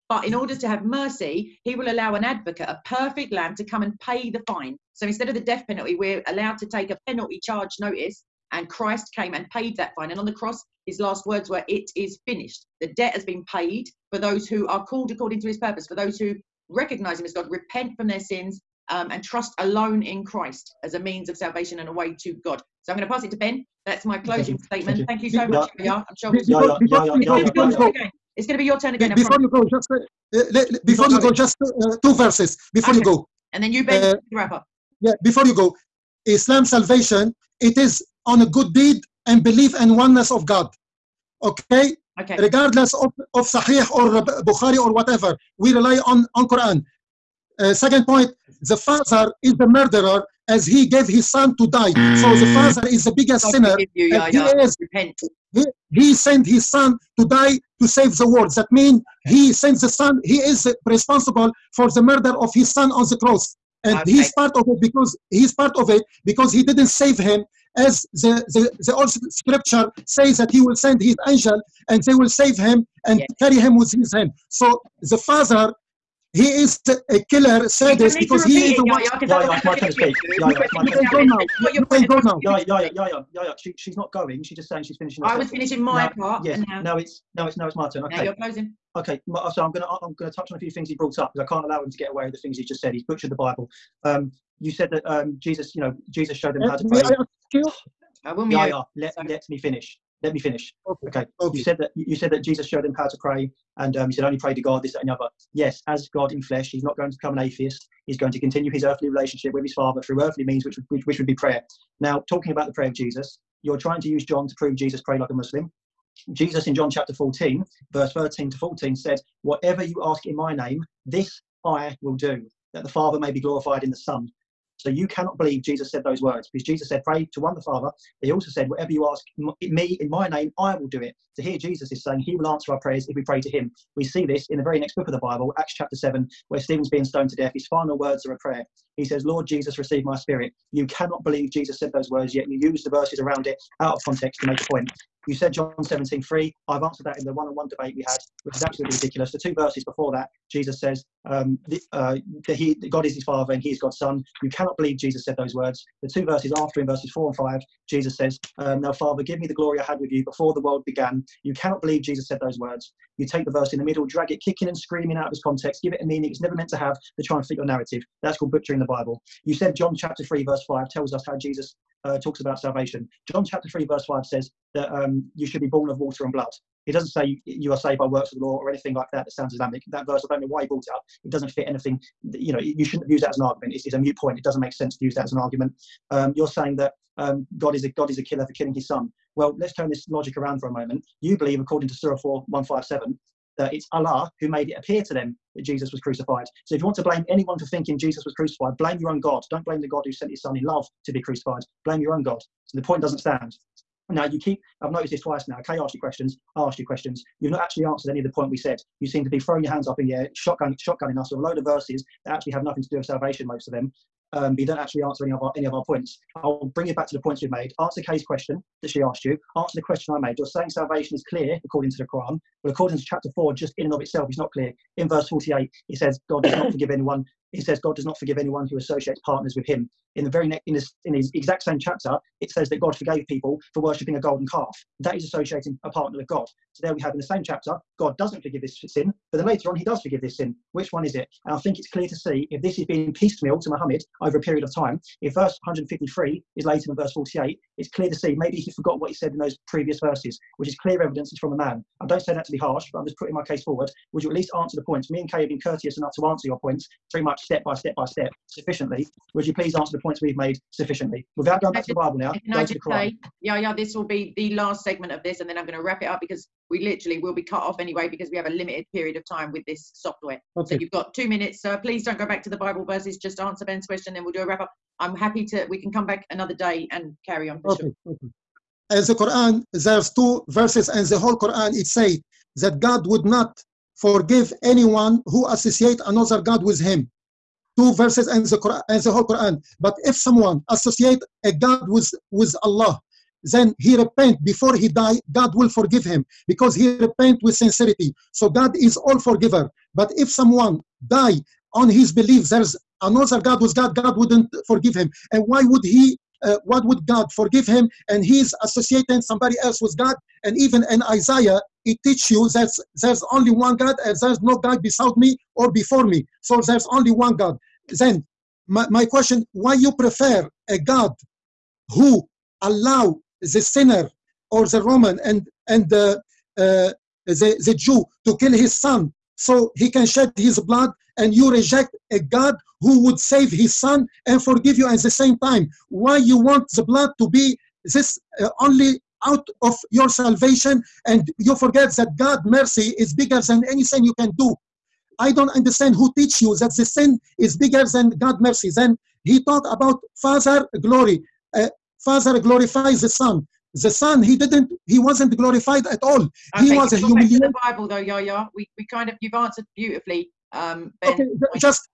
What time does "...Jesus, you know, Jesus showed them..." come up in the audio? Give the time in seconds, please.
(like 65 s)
95 s.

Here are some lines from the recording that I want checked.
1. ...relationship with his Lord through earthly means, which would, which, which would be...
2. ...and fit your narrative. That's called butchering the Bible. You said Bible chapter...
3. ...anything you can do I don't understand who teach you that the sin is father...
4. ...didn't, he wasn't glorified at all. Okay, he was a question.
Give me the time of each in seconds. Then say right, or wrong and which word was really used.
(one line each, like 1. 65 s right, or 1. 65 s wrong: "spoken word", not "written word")
1. 109 s wrong: "Father", not "Lord"
2. 167 s wrong: "John", not "Bible"
3. 343 s wrong: "bigger", not "father"
4. 354 s wrong: "humiliation", not "question".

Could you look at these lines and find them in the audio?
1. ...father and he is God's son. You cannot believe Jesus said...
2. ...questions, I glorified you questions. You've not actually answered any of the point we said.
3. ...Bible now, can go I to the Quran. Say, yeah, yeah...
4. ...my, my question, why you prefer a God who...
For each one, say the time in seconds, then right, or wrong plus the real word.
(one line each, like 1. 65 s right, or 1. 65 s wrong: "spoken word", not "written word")
1. 153 s right
2. 205 s wrong: "asked", not "glorified"
3. 261 s right
4. 318 s right.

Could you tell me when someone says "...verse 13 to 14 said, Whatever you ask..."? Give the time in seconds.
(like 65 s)
117 s.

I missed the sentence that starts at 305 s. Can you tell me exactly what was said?
And why would he, uh, what would God forgive him?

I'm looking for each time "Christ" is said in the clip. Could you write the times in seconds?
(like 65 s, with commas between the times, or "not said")
8 s, 20 s.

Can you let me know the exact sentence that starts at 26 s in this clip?
I'm sure yeah, yeah, yeah, yeah, yeah, yeah, It's going to be your turn again.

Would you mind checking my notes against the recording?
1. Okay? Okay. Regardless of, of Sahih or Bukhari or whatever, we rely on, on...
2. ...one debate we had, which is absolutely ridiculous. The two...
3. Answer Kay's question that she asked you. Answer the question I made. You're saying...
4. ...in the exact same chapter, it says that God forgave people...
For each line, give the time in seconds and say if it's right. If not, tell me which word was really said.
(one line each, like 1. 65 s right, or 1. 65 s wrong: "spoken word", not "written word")
1. 41 s right
2. 147 s right
3. 217 s right
4. 231 s right.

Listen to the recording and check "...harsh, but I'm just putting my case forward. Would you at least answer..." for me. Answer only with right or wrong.
right.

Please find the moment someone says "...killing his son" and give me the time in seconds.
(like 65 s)
188 s.